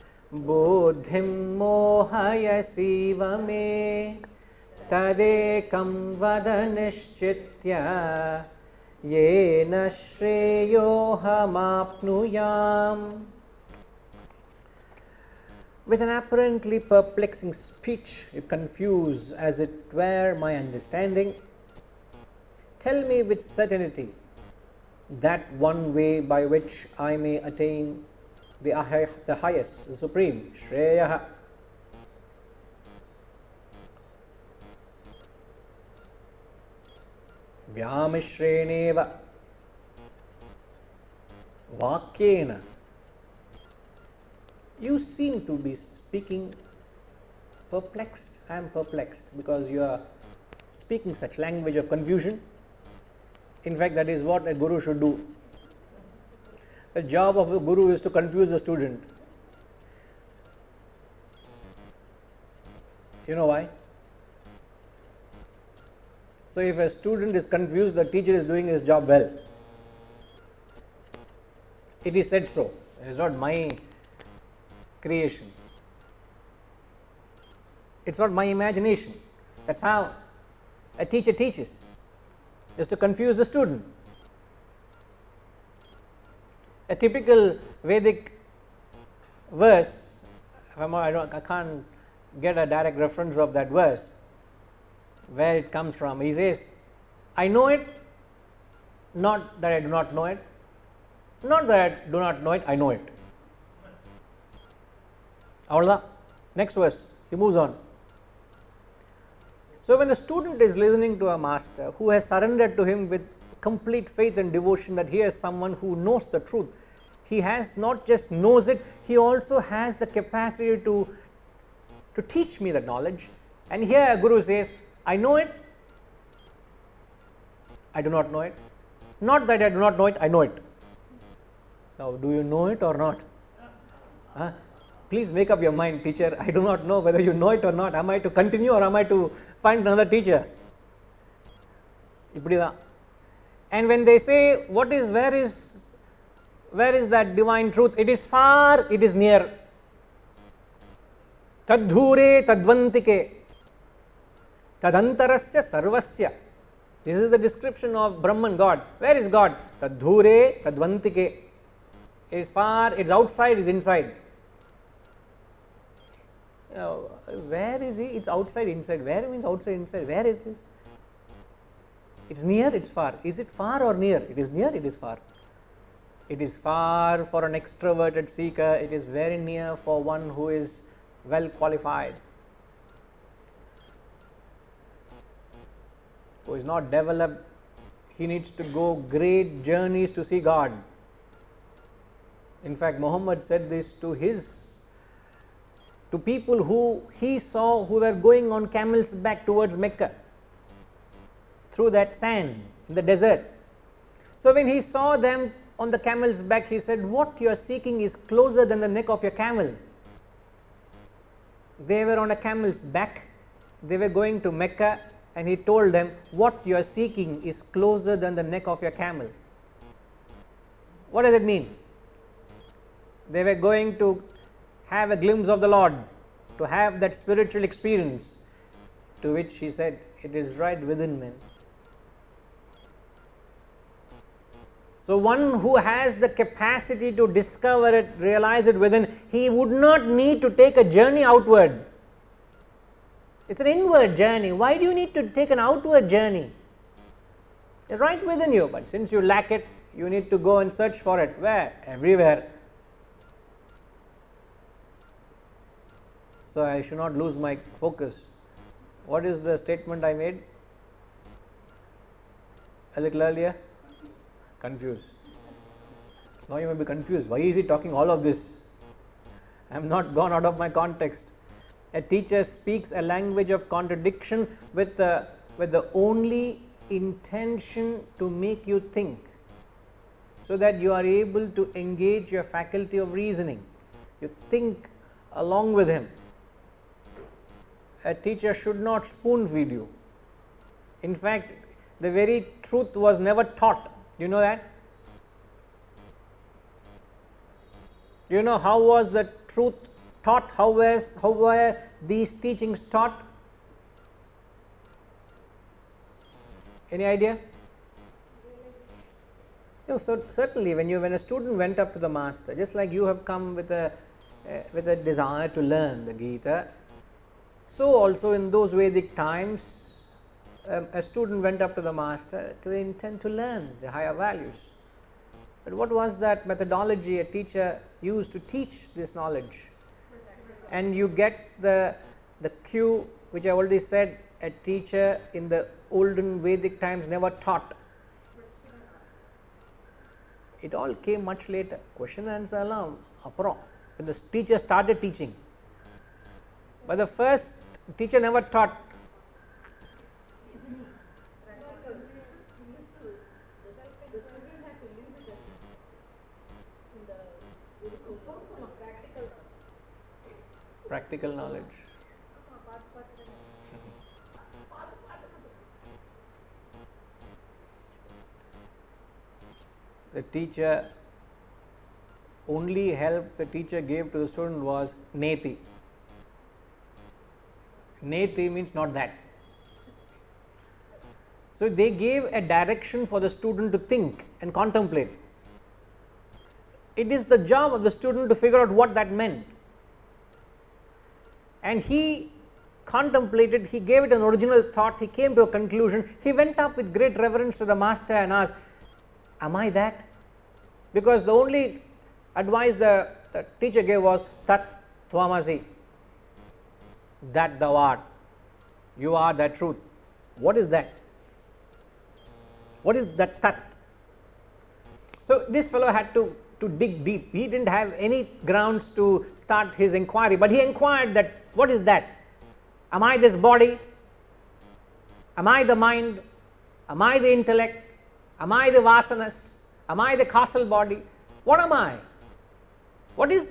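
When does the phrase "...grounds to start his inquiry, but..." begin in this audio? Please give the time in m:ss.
6:58.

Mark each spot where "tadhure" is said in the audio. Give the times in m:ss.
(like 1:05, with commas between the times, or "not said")
2:31, 2:39.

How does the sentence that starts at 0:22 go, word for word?
Tell me with certainty that one way by which I may attain the, high, the highest, the supreme, Shreyaha.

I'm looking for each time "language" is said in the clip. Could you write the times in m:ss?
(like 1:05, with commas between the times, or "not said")
0:51, 4:33.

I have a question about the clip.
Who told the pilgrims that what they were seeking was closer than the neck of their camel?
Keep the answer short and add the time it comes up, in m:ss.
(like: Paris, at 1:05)
Muhammad, at 3:12.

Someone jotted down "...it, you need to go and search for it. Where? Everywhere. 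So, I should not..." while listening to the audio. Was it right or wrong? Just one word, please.
right.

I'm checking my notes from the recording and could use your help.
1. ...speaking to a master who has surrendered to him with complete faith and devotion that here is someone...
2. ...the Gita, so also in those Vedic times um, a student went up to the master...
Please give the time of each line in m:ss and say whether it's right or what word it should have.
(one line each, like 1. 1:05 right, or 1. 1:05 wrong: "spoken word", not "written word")
1. 1:50 wrong: "listening", not "speaking"
2. 5:16 right.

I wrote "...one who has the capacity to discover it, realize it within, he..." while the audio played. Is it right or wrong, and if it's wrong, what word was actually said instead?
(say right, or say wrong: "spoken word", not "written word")
right.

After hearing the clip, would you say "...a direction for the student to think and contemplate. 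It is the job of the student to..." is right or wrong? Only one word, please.
right.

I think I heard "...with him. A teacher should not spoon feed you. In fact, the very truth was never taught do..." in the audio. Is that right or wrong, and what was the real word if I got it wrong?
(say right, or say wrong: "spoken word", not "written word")
right.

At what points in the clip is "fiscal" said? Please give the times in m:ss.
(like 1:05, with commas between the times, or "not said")
not said.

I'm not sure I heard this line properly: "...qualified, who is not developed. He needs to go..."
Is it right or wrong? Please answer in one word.
right.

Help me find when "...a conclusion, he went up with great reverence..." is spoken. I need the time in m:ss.
6:35.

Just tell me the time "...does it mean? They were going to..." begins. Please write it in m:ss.
3:41.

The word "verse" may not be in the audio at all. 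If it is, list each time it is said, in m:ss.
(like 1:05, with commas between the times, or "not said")
1:29, 1:33, 1:46.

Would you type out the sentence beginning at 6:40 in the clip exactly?
Because the only advice the, the teacher gave was, tat thwamasi." that thou art, you are that truth.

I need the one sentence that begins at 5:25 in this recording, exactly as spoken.
But what was that methodology a teacher used to teach this knowledge?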